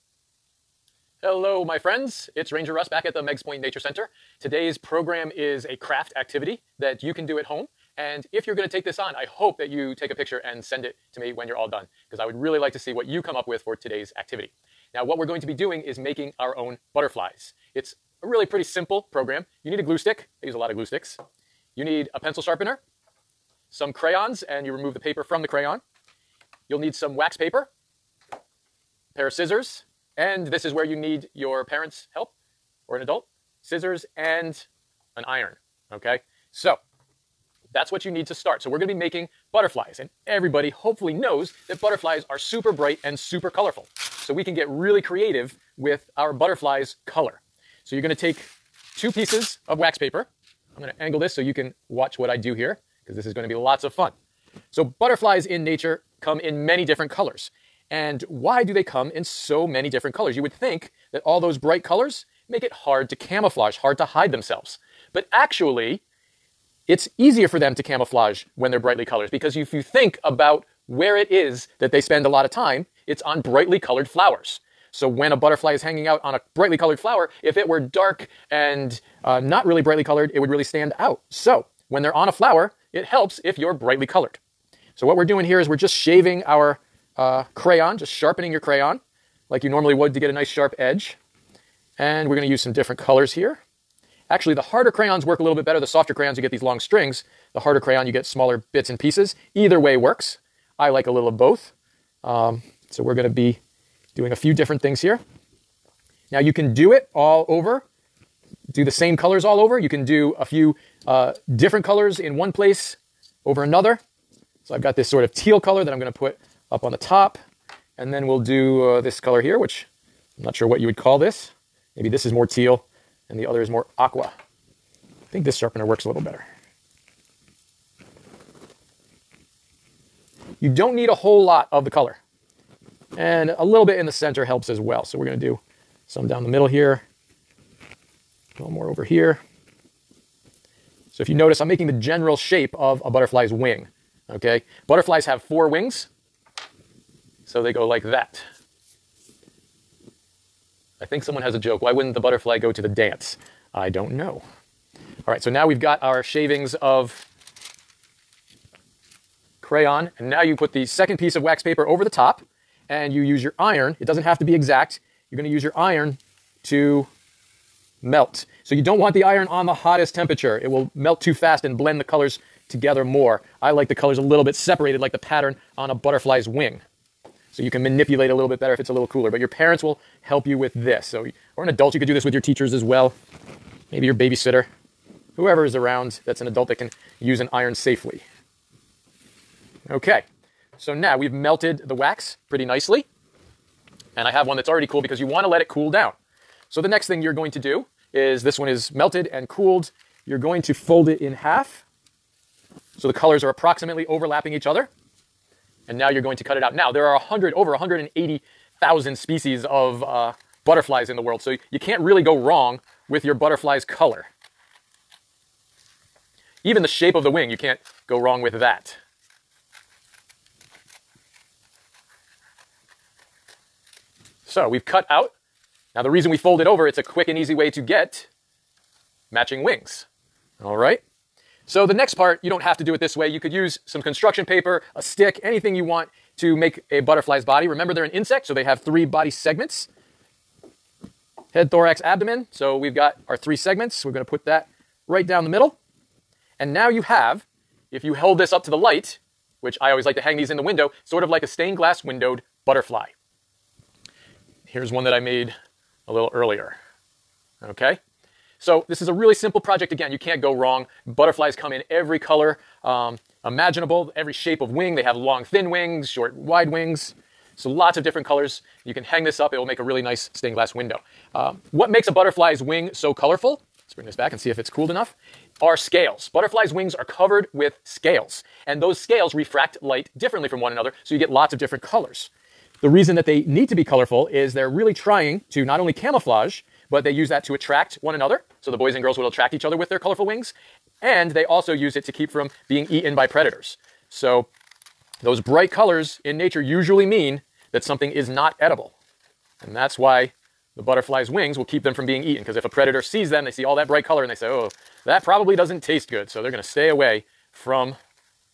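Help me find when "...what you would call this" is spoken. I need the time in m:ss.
2:00.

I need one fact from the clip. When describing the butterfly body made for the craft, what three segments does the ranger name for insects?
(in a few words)
head, thorax, abdomen.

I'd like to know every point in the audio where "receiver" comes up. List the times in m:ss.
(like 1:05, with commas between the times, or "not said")
not said.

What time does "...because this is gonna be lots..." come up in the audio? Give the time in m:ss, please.
0:53.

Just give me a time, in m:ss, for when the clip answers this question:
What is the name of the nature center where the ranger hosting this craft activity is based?
0:03.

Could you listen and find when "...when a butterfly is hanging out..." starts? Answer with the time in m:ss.
1:15.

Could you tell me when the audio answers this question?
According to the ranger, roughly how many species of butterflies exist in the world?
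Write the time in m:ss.
3:27.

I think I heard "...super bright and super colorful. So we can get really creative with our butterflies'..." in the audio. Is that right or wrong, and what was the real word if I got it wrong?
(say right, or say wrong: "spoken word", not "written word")
right.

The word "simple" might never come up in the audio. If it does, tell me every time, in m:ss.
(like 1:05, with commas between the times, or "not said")
0:18, 4:19.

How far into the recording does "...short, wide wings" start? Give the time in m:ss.
4:26.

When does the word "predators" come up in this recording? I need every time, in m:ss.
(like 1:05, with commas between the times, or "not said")
4:53, 5:02.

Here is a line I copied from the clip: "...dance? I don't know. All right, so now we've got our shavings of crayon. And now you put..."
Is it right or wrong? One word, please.
right.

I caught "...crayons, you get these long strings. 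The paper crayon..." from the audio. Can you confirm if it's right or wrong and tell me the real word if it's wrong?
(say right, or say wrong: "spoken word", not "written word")
wrong: "harder", not "paper".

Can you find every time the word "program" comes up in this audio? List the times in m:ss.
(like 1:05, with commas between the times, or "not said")
0:04, 0:19.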